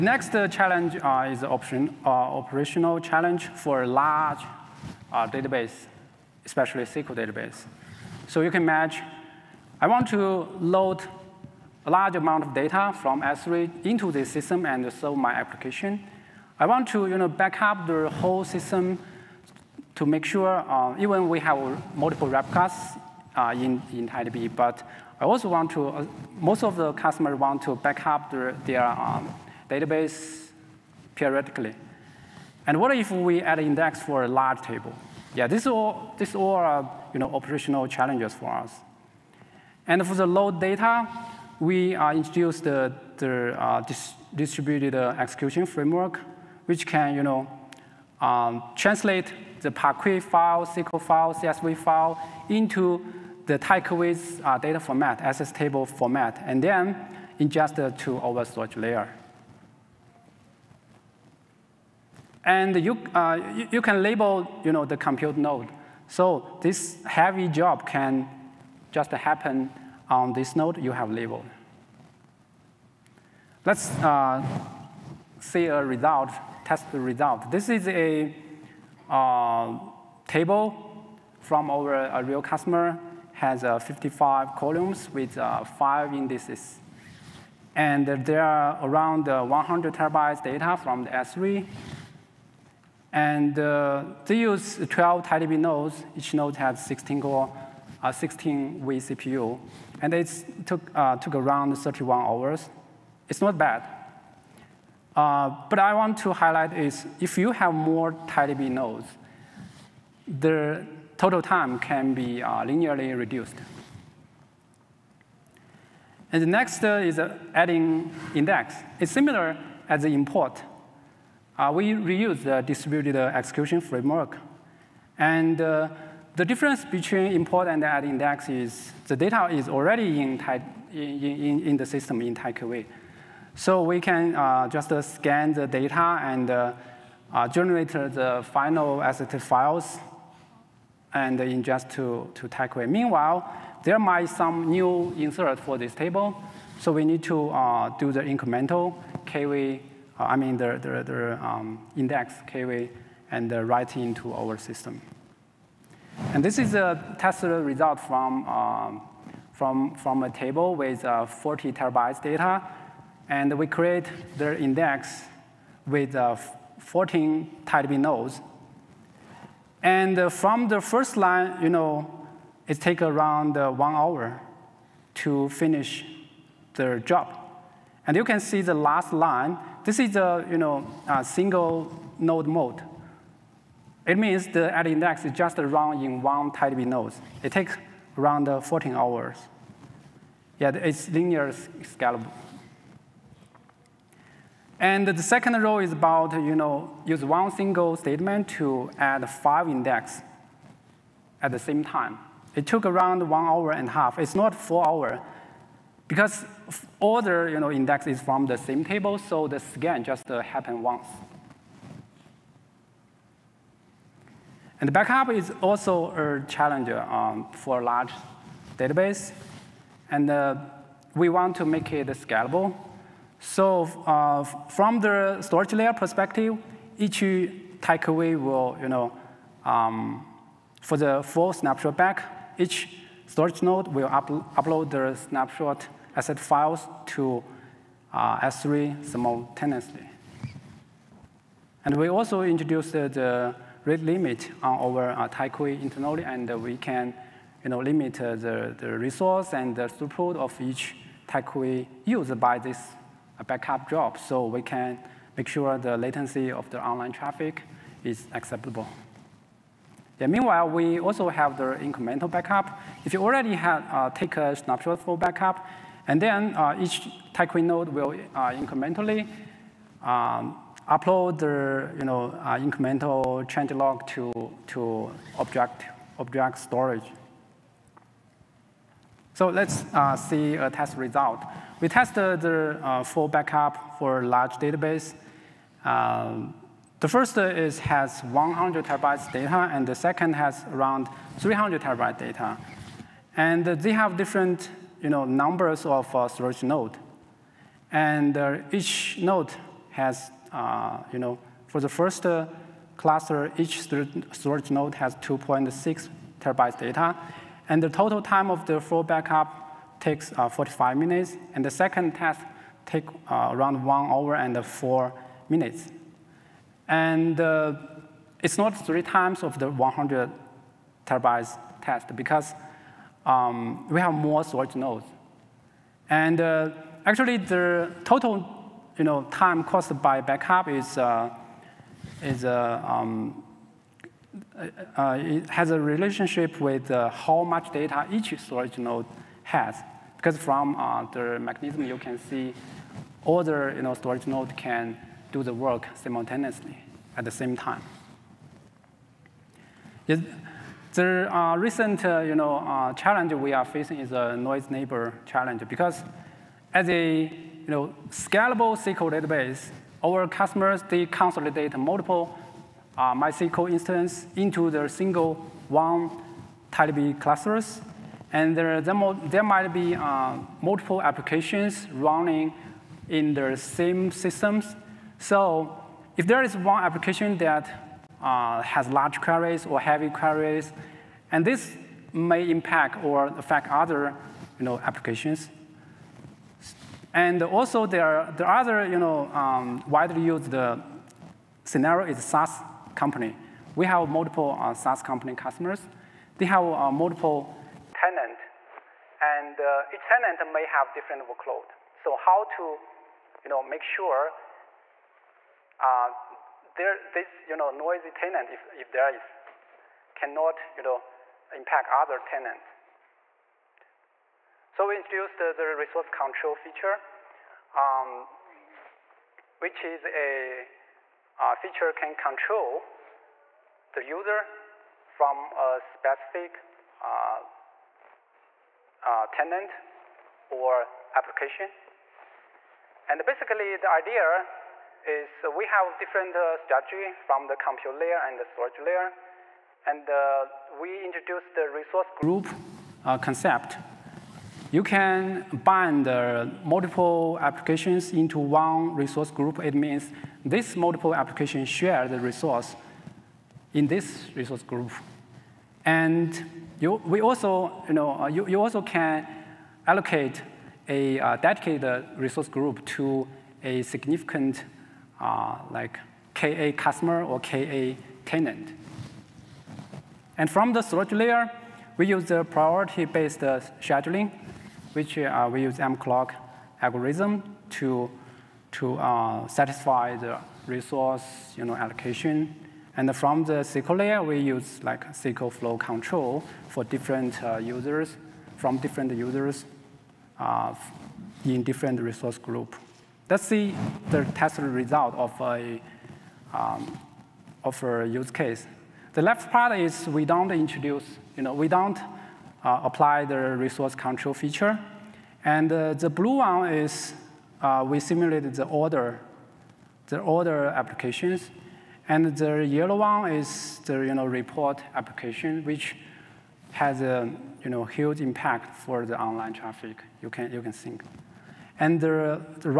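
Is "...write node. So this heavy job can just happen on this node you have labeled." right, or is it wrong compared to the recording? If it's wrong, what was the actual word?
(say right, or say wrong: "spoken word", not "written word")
wrong: "compute", not "write".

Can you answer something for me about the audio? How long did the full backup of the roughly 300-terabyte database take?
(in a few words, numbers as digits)
1 hour 4 minutes.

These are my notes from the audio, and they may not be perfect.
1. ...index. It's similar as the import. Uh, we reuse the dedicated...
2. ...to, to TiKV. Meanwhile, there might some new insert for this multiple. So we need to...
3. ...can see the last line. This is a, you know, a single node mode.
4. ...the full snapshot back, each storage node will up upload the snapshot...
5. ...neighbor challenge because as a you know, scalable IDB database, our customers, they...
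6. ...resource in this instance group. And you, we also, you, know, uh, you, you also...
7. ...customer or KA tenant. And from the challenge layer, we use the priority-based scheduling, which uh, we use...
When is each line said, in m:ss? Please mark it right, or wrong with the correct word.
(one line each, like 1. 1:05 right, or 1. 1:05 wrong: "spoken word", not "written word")
1. 1:58 wrong: "distributed", not "dedicated"
2. 2:21 wrong: "table", not "multiple"
3. 2:58 right
4. 3:50 right
5. 5:54 wrong: "SQL", not "IDB"
6. 7:32 wrong: "resource", not "instance"
7. 7:46 wrong: "storage", not "challenge".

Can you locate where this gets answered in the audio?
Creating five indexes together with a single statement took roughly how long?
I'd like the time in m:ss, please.
3:23.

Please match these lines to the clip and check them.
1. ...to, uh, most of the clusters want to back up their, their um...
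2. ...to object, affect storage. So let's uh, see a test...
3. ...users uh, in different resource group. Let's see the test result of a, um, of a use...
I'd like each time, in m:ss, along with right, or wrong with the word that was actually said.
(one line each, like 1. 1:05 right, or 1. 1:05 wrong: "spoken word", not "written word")
1. 0:25 wrong: "customers", not "clusters"
2. 4:34 wrong: "object", not "affect"
3. 8:09 right.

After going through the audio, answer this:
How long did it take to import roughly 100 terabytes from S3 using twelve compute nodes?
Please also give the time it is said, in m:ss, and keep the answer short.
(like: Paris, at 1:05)
31 hours, at 1:41.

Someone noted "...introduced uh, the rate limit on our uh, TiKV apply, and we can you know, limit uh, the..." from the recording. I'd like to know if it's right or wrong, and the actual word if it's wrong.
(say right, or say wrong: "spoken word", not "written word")
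wrong: "internally", not "apply".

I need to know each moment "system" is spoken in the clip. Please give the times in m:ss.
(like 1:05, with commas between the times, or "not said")
0:14, 0:18, 2:11, 2:34, 6:14.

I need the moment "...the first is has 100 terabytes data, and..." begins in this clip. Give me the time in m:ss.
4:46.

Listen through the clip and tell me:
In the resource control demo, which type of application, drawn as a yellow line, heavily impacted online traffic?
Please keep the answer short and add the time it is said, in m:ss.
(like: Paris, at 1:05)
report application, at 8:34.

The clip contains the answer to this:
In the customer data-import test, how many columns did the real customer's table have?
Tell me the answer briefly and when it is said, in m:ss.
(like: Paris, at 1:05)
55, at 1:23.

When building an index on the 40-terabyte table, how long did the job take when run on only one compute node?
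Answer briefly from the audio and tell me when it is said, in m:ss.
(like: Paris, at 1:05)
14 hours, at 3:08.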